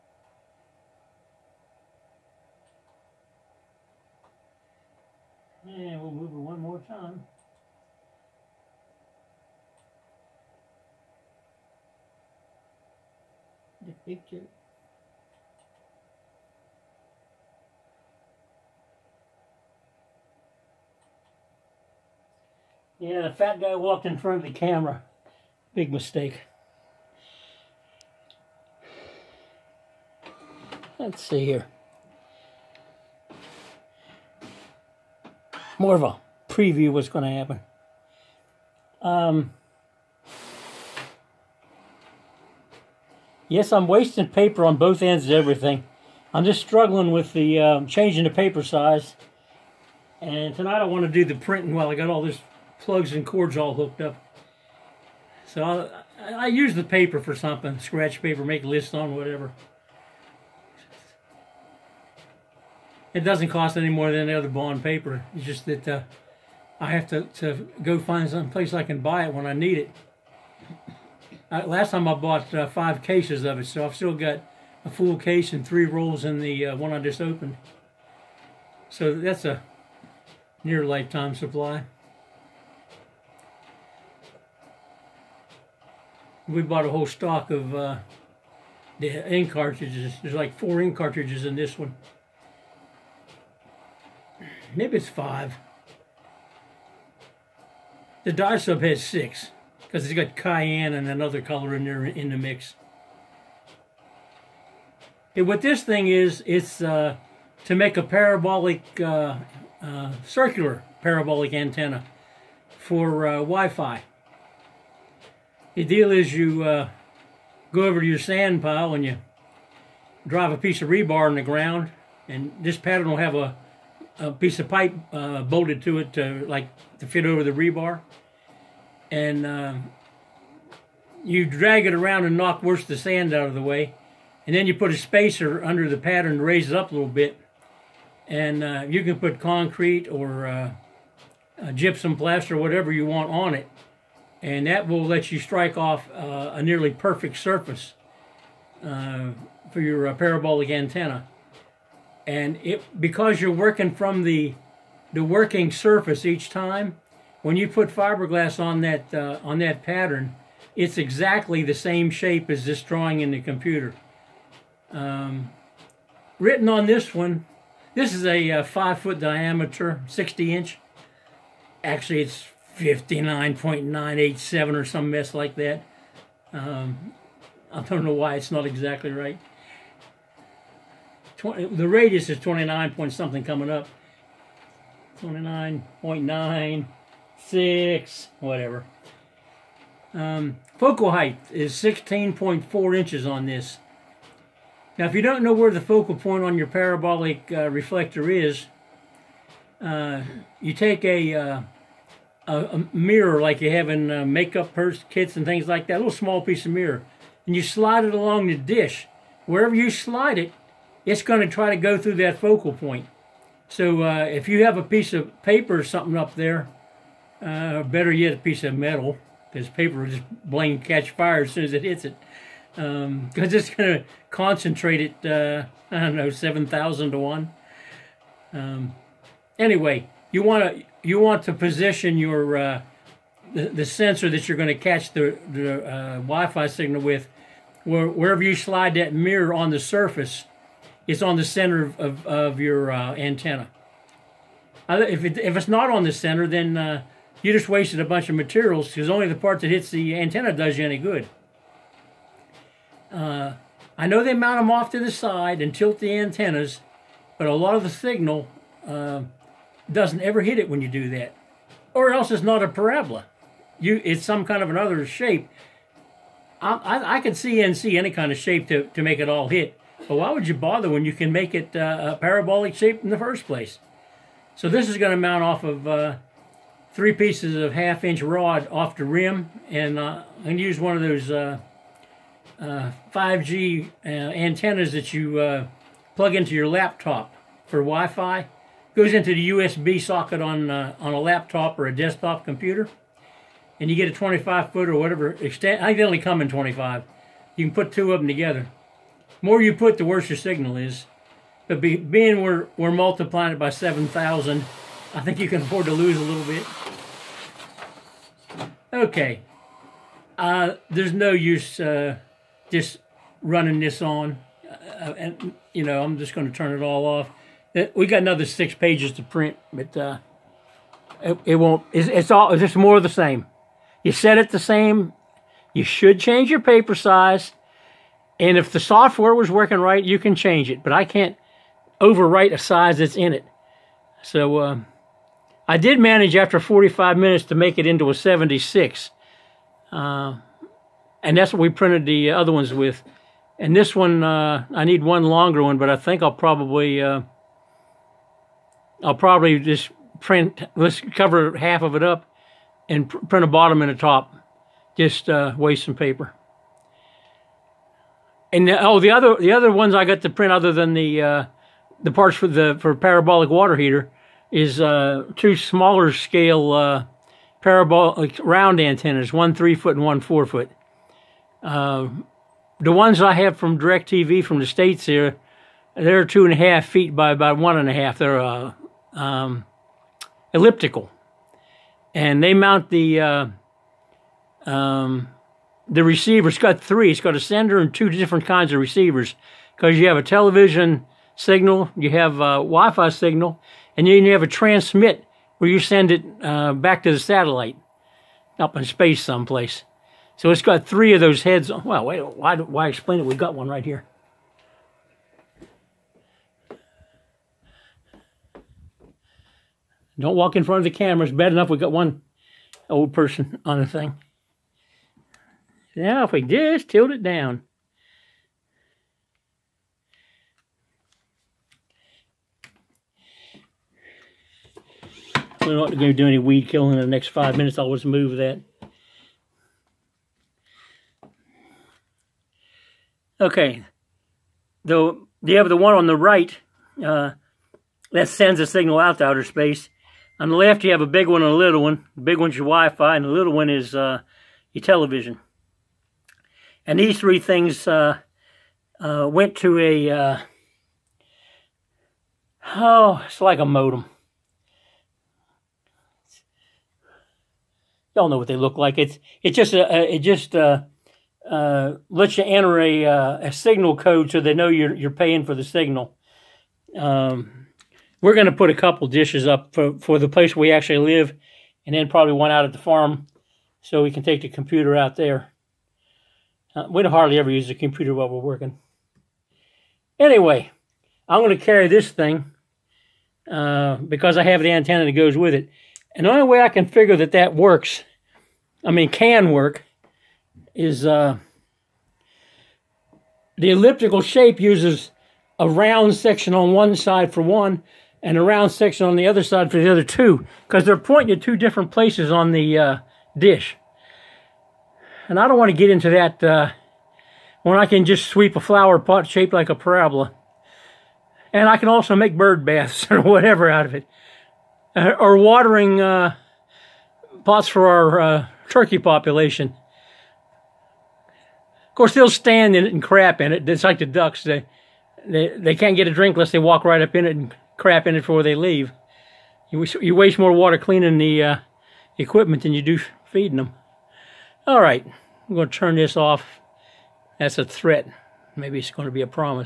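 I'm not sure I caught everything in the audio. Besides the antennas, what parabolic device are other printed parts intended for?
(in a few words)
water heater.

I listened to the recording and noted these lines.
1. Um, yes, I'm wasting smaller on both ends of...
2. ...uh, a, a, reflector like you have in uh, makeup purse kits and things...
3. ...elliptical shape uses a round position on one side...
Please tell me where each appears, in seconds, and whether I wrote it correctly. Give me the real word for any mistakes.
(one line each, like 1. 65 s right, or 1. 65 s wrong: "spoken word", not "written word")
1. 39 s wrong: "paper", not "smaller"
2. 201 s wrong: "mirror", not "reflector"
3. 493 s wrong: "section", not "position".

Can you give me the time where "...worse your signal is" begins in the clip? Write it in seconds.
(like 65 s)
300 s.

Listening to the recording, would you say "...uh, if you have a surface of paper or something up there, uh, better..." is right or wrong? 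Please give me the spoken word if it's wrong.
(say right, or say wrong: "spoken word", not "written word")
wrong: "piece", not "surface".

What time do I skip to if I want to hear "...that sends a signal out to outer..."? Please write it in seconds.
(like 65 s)
438 s.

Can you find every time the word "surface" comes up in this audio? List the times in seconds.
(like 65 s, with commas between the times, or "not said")
147 s, 155 s, 239 s.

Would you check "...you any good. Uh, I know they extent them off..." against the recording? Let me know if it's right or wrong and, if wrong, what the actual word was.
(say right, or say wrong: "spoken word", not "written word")
wrong: "mount", not "extent".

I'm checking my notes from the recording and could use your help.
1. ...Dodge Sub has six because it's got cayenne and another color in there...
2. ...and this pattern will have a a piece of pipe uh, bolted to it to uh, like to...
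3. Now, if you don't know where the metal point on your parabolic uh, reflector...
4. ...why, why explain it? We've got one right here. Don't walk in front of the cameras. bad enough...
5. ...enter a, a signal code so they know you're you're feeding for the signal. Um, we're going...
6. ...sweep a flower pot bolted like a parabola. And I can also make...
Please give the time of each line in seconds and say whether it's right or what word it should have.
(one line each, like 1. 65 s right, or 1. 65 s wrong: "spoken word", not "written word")
1. 98 s right
2. 122 s right
3. 194 s wrong: "focal", not "metal"
4. 402 s right
5. 462 s wrong: "paying", not "feeding"
6. 508 s wrong: "shaped", not "bolted".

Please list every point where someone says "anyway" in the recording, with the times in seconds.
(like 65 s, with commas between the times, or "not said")
229 s, 480 s.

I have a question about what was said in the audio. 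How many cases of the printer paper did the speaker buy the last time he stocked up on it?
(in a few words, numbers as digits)
5.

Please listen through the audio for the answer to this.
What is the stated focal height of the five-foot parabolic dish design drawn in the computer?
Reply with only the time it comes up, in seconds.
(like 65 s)
191 s.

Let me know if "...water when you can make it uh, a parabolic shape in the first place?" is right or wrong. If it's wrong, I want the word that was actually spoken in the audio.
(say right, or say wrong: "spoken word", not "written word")
wrong: "bother", not "water".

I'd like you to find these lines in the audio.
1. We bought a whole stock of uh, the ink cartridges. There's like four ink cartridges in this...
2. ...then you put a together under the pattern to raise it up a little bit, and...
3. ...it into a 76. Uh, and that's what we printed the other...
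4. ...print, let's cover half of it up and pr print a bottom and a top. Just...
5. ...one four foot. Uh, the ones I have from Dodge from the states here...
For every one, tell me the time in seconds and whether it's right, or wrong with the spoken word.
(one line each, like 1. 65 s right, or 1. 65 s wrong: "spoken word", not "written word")
1. 86 s right
2. 134 s wrong: "spacer", not "together"
3. 337 s right
4. 350 s right
5. 370 s wrong: "DirecTV", not "Dodge".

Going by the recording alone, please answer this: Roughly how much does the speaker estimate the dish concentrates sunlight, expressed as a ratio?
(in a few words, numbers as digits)
7,000 to 1.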